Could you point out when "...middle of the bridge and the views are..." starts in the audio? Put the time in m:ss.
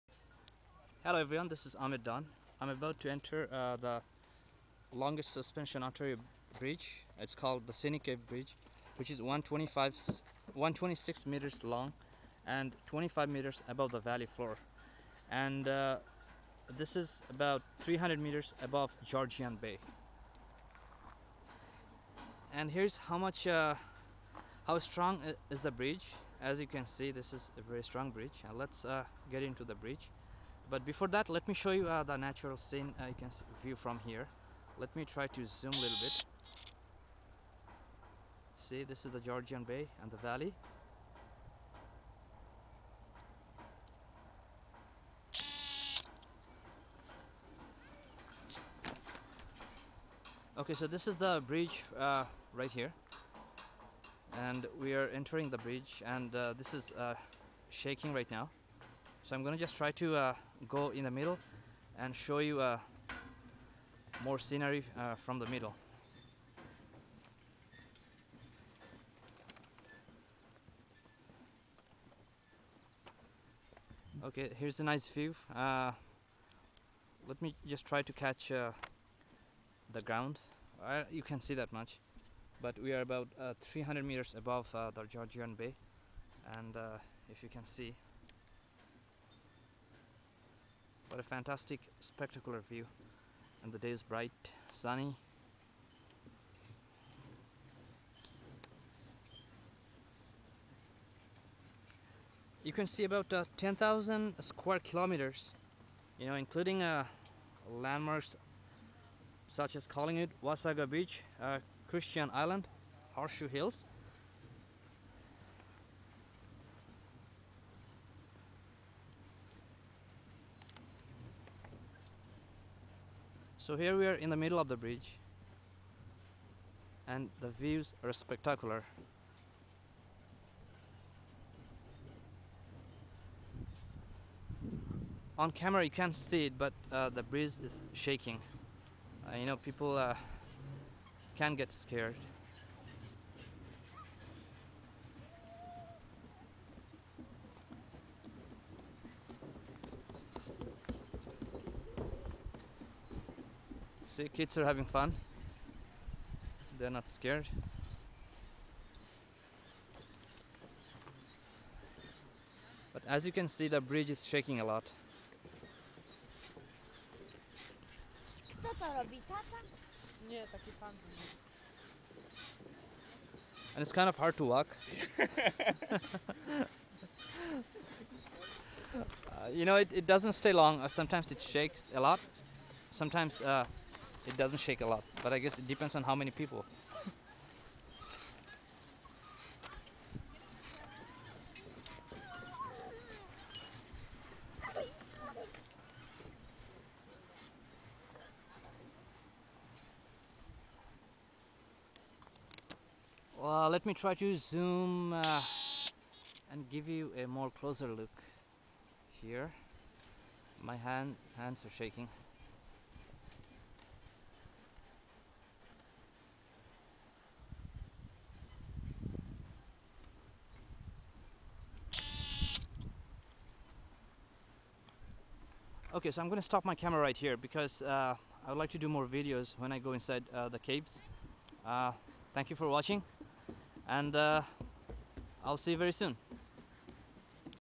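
2:04.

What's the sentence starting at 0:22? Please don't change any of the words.
And here's how much, uh, how strong is the bridge.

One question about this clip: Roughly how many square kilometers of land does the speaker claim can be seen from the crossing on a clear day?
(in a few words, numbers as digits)
10,000.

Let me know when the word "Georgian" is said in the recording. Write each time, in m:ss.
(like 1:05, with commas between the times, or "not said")
0:19, 0:39, 1:25.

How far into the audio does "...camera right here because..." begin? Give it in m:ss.
3:46.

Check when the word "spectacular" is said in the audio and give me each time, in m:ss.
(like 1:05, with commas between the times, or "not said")
1:31, 2:08.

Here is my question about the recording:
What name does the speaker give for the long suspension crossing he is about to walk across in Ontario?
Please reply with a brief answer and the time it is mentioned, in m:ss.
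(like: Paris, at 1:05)
Scenic Bridge, at 0:07.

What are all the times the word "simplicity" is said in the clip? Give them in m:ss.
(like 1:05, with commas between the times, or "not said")
not said.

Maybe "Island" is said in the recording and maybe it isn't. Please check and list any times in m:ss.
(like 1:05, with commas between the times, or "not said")
1:52.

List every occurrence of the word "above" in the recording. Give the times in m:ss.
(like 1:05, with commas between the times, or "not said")
0:13, 0:18, 1:24.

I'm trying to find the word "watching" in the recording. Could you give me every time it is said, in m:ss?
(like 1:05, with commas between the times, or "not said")
3:52.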